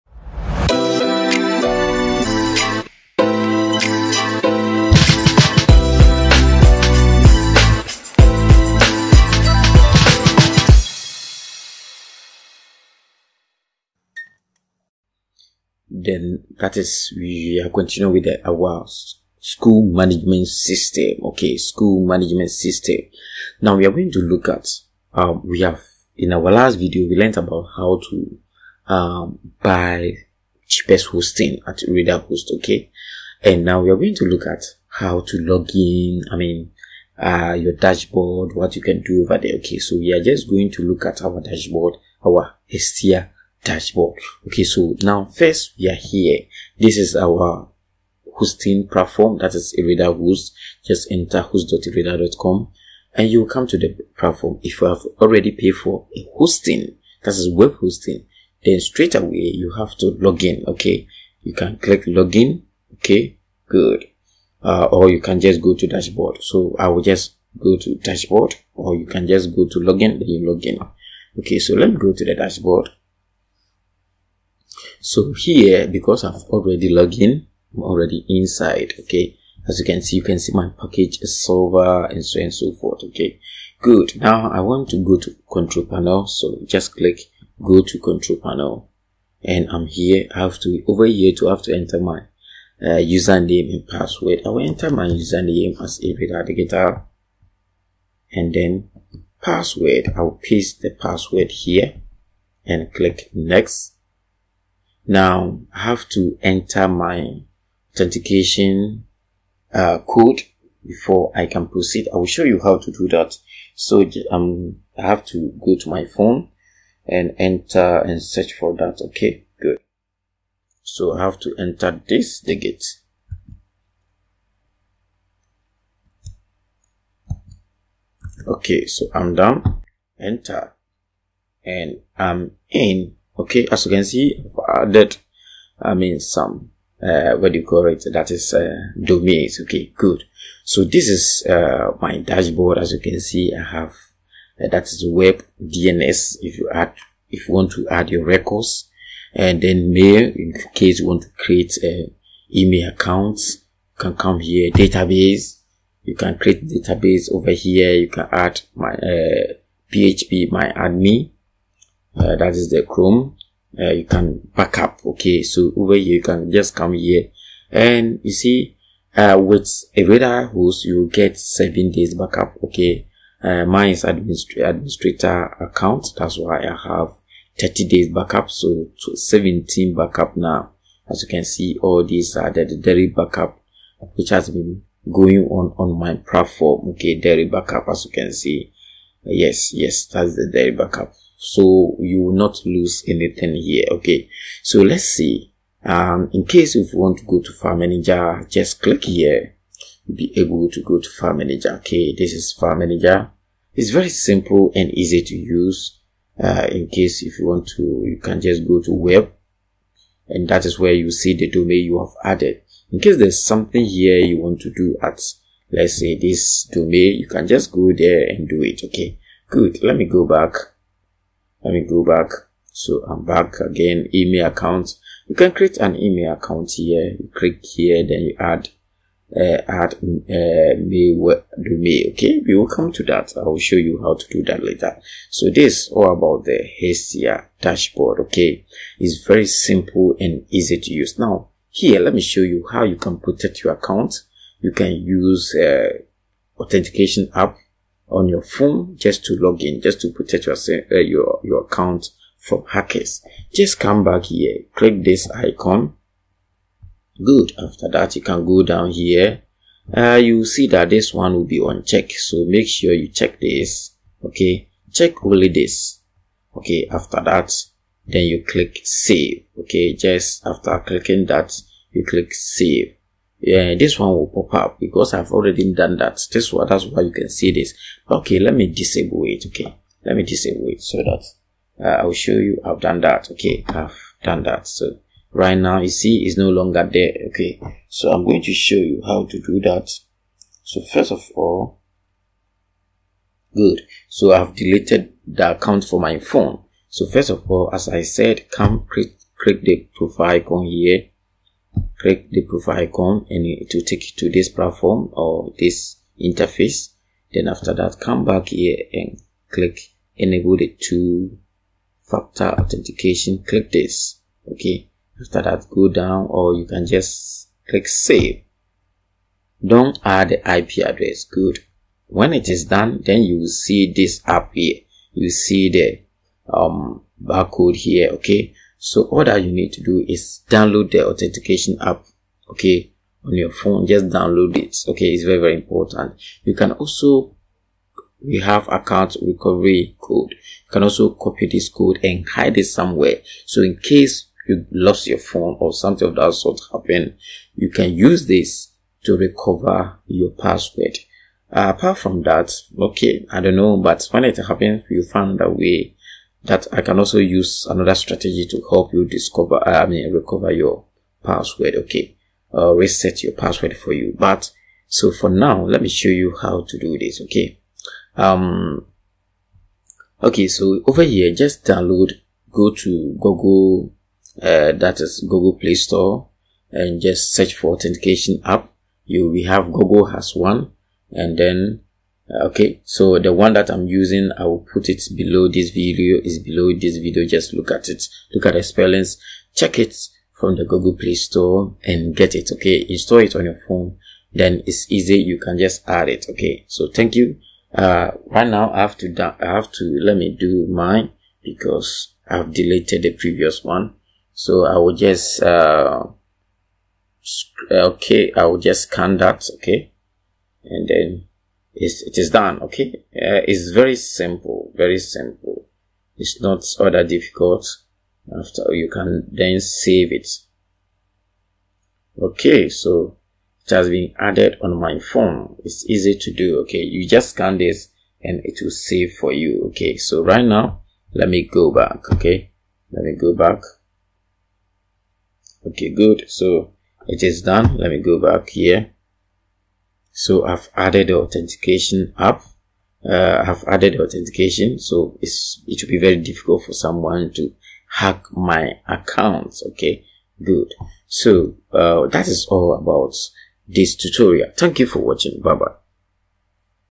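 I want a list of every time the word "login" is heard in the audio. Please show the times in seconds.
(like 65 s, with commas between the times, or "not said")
62 s, 69 s.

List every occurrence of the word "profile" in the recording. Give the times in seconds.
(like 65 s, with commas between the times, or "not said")
299 s.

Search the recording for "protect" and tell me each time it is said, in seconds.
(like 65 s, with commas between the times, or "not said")
243 s, 250 s.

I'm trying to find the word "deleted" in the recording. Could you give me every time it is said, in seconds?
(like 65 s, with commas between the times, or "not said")
294 s, 402 s.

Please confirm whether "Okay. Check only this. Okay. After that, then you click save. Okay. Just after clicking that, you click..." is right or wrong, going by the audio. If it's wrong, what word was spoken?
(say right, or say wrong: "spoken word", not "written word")
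right.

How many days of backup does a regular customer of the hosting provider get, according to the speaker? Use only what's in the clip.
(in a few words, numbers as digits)
7 days.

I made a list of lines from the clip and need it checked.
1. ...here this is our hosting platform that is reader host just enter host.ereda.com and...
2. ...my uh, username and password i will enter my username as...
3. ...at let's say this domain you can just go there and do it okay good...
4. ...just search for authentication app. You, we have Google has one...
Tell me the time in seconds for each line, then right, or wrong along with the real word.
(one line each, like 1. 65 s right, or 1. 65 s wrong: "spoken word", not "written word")
1. 45 s right
2. 91 s right
3. 215 s right
4. 377 s right.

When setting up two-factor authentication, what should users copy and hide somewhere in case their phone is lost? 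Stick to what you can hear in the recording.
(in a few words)
Account recovery code.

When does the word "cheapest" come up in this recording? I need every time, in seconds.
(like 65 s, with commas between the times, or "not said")
30 s.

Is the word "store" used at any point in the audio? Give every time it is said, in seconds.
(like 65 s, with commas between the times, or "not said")
375 s, 391 s.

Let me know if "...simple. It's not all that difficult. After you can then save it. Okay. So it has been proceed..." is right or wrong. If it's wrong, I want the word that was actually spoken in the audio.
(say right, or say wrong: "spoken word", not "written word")
wrong: "added", not "proceed".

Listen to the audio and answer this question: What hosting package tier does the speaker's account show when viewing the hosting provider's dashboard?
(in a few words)
Silver.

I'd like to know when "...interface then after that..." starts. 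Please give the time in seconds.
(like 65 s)
306 s.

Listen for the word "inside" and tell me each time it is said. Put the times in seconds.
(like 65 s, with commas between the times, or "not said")
78 s.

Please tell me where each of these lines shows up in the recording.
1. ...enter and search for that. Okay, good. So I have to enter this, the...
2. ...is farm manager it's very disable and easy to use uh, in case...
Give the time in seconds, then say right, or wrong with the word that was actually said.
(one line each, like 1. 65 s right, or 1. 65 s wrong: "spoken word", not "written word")
1. 117 s right
2. 202 s wrong: "simple", not "disable".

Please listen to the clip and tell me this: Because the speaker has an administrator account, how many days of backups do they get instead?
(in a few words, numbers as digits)
30 days.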